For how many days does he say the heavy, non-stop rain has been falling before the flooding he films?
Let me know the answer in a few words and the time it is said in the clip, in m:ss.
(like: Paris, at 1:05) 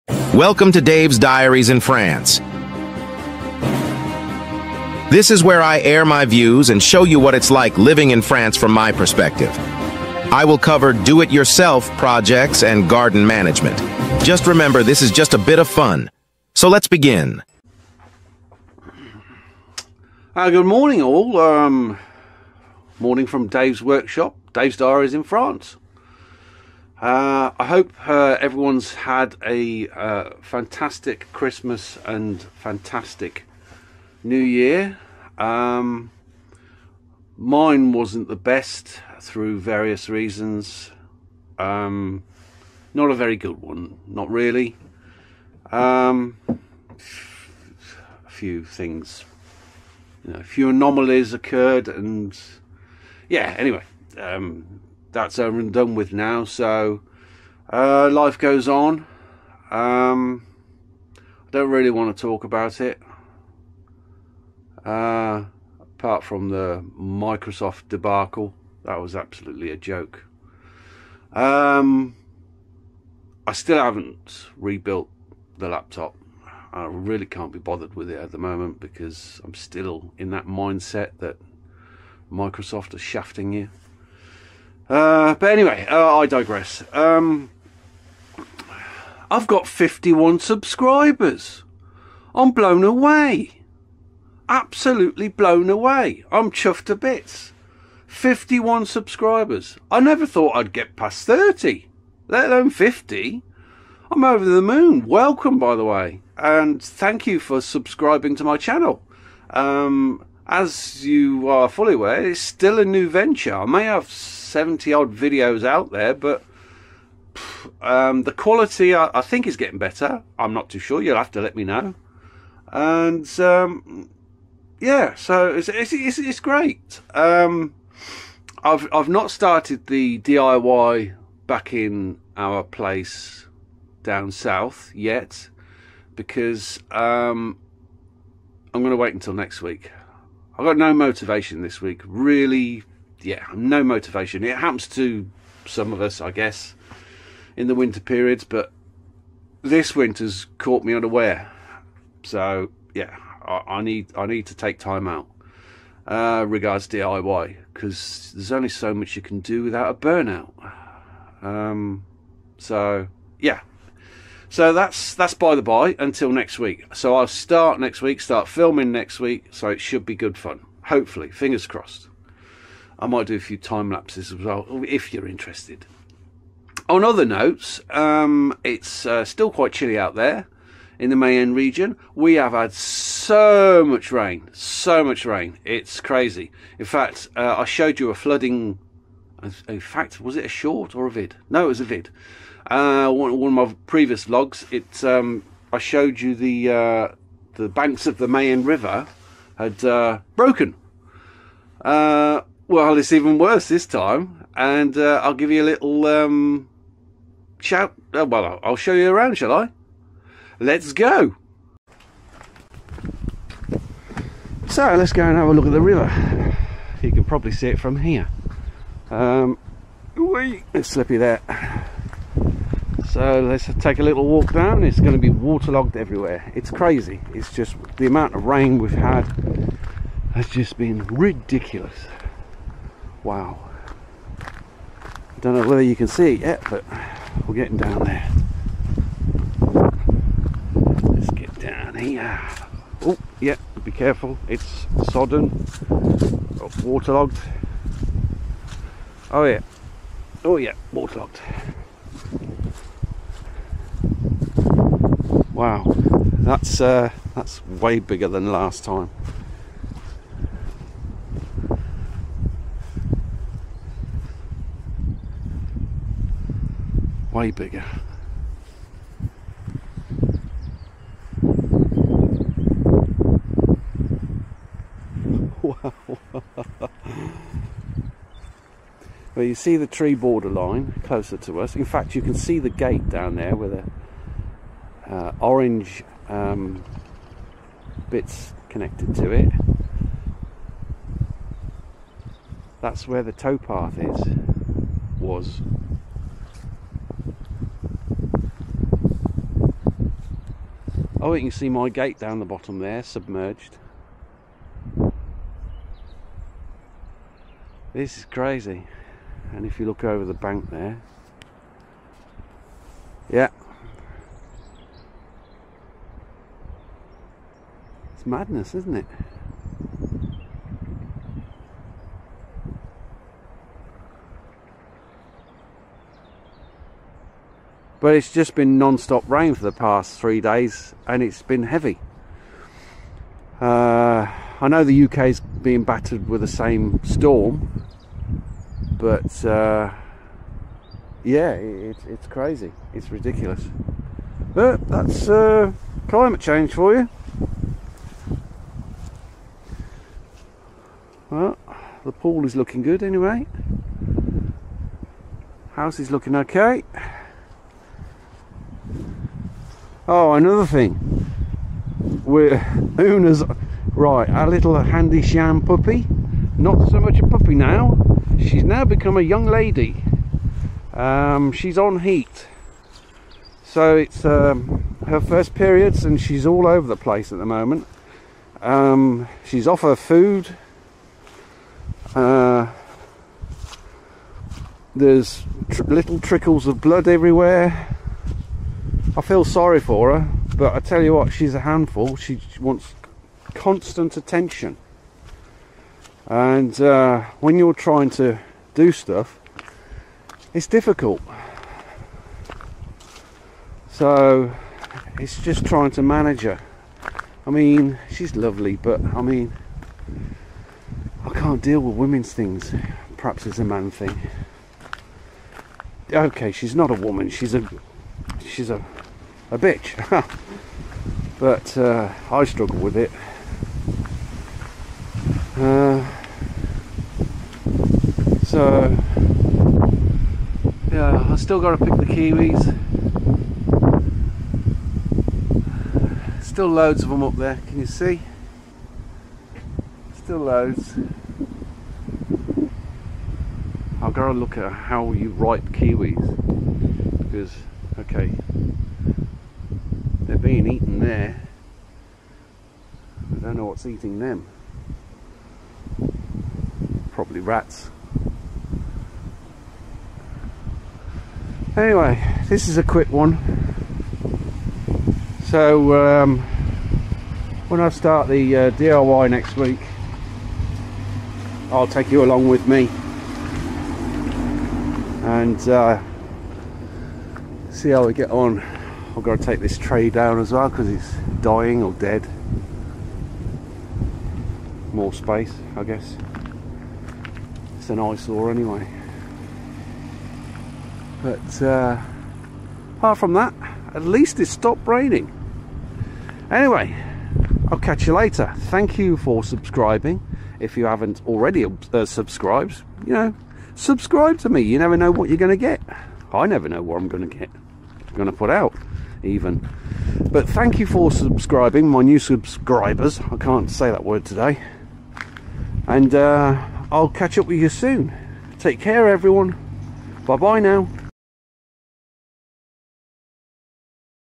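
3, at 5:30.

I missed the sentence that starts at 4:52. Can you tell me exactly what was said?
That's where the towpath is, was.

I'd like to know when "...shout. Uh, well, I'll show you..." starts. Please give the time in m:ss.
3:27.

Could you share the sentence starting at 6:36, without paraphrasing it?
And uh, when you're trying to do stuff, it's difficult.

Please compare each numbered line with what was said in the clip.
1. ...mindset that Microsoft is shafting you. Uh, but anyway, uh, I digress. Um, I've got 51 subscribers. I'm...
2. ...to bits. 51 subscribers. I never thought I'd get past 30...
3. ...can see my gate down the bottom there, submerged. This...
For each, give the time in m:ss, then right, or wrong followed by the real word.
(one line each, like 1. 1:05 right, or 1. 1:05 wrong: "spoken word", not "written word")
1. 1:20 right
2. 1:36 right
3. 5:01 right.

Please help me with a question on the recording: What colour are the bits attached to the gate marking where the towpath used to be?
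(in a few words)
Orange.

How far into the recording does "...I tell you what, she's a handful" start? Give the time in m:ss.
6:30.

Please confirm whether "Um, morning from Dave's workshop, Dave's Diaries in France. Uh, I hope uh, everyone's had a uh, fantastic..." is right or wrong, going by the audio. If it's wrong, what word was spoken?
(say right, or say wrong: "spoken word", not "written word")
right.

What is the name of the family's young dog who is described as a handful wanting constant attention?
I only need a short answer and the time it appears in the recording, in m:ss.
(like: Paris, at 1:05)
Una, at 6:02.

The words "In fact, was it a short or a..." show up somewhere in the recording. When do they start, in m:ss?
3:09.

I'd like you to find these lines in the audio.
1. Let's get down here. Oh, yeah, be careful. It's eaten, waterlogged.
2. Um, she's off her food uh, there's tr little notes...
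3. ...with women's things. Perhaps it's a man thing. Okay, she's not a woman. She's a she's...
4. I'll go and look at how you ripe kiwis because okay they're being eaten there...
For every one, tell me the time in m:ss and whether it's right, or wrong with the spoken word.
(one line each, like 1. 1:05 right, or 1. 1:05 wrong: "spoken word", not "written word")
1. 4:01 wrong: "sodden", not "eaten"
2. 6:18 wrong: "trickles", not "notes"
3. 6:51 right
4. 7:24 right.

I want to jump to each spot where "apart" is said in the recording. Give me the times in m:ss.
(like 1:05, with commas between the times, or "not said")
1:05, 8:12.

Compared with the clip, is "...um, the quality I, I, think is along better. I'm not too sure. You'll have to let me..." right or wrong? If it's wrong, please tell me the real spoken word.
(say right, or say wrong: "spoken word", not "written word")
wrong: "getting", not "along".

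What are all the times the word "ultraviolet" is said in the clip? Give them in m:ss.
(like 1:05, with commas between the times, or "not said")
not said.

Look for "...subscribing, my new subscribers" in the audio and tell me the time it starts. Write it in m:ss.
8:31.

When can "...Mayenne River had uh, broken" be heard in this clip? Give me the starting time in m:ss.
3:18.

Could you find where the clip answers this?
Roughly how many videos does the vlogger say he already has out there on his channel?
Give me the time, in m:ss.
1:54.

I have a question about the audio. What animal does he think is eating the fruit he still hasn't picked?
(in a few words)
Rats.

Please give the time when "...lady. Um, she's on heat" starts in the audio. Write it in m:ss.
6:09.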